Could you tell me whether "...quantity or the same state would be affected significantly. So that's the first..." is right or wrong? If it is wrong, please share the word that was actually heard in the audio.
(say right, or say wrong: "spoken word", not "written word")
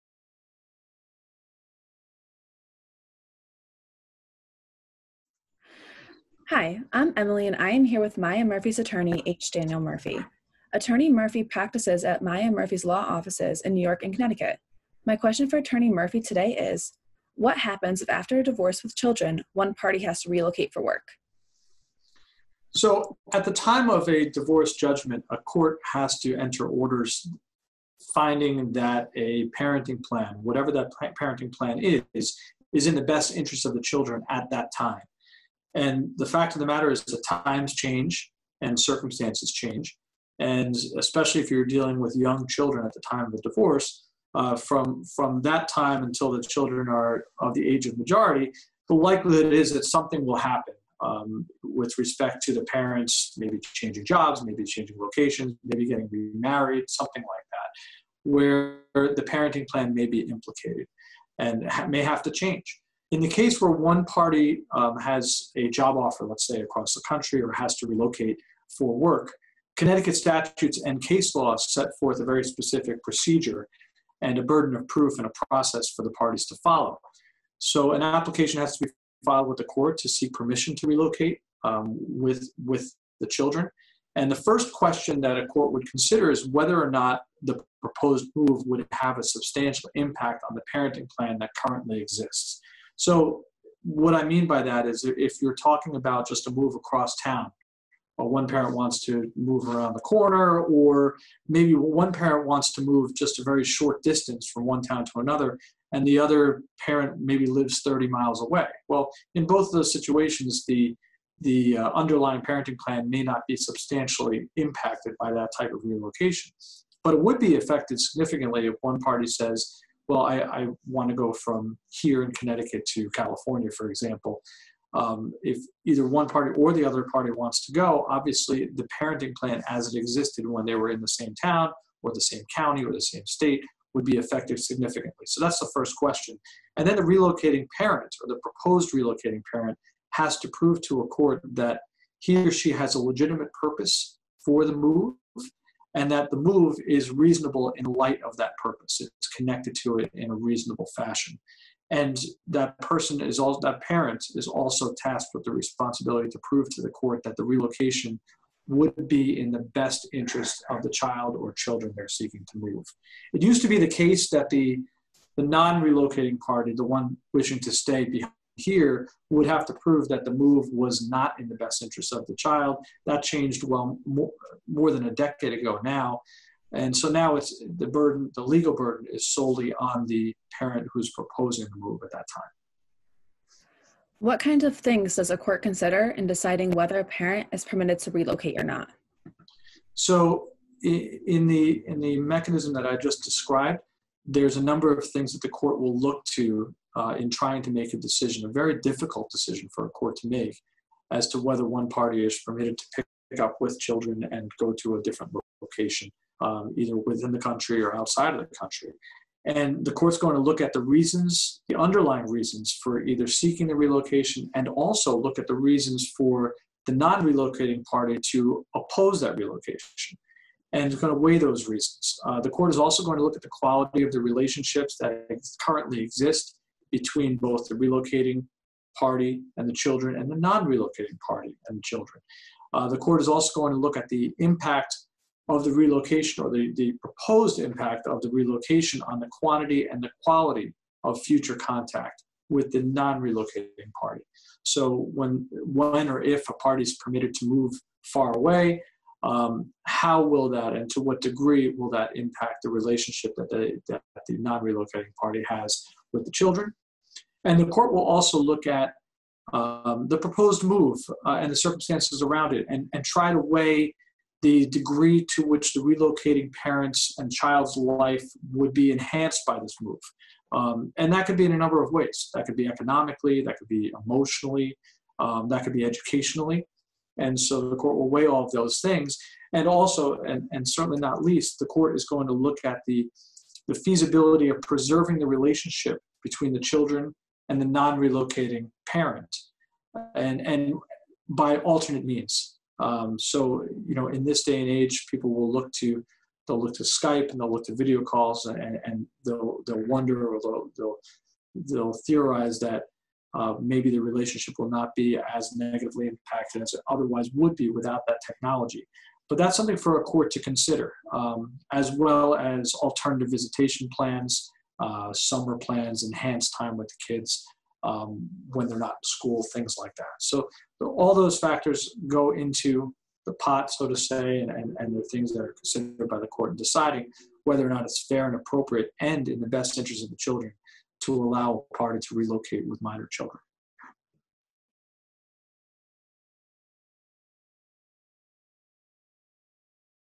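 wrong: "county", not "quantity".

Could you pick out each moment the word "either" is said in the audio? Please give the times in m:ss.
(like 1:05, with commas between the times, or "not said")
2:05, 3:26, 3:33.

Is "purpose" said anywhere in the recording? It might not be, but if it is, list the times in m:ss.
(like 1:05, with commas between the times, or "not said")
2:23, 2:28.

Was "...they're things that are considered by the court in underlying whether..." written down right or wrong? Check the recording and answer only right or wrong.
wrong.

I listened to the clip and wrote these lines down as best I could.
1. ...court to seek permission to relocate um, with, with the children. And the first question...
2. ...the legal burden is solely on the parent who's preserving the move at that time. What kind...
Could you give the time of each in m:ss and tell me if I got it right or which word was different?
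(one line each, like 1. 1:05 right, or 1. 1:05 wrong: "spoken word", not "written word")
1. 1:19 right
2. 2:58 wrong: "proposing", not "preserving".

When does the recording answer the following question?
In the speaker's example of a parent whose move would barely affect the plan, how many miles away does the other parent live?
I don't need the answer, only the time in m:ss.
1:47.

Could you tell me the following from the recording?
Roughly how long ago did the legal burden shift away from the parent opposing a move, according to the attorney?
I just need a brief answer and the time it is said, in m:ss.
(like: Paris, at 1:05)
more than a decade, at 2:54.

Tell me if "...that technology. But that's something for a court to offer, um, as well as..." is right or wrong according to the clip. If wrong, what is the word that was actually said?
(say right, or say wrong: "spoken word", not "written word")
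wrong: "consider", not "offer".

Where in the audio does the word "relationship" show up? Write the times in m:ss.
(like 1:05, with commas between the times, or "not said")
3:44, 4:12, 4:45, 5:03.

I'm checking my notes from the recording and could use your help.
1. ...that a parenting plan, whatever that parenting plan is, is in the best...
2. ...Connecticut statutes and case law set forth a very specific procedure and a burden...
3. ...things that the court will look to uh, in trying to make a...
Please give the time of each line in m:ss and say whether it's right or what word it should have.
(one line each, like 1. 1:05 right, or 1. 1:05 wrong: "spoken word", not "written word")
1. 0:28 right
2. 1:09 right
3. 3:15 right.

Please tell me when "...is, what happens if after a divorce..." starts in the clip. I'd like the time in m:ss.
0:16.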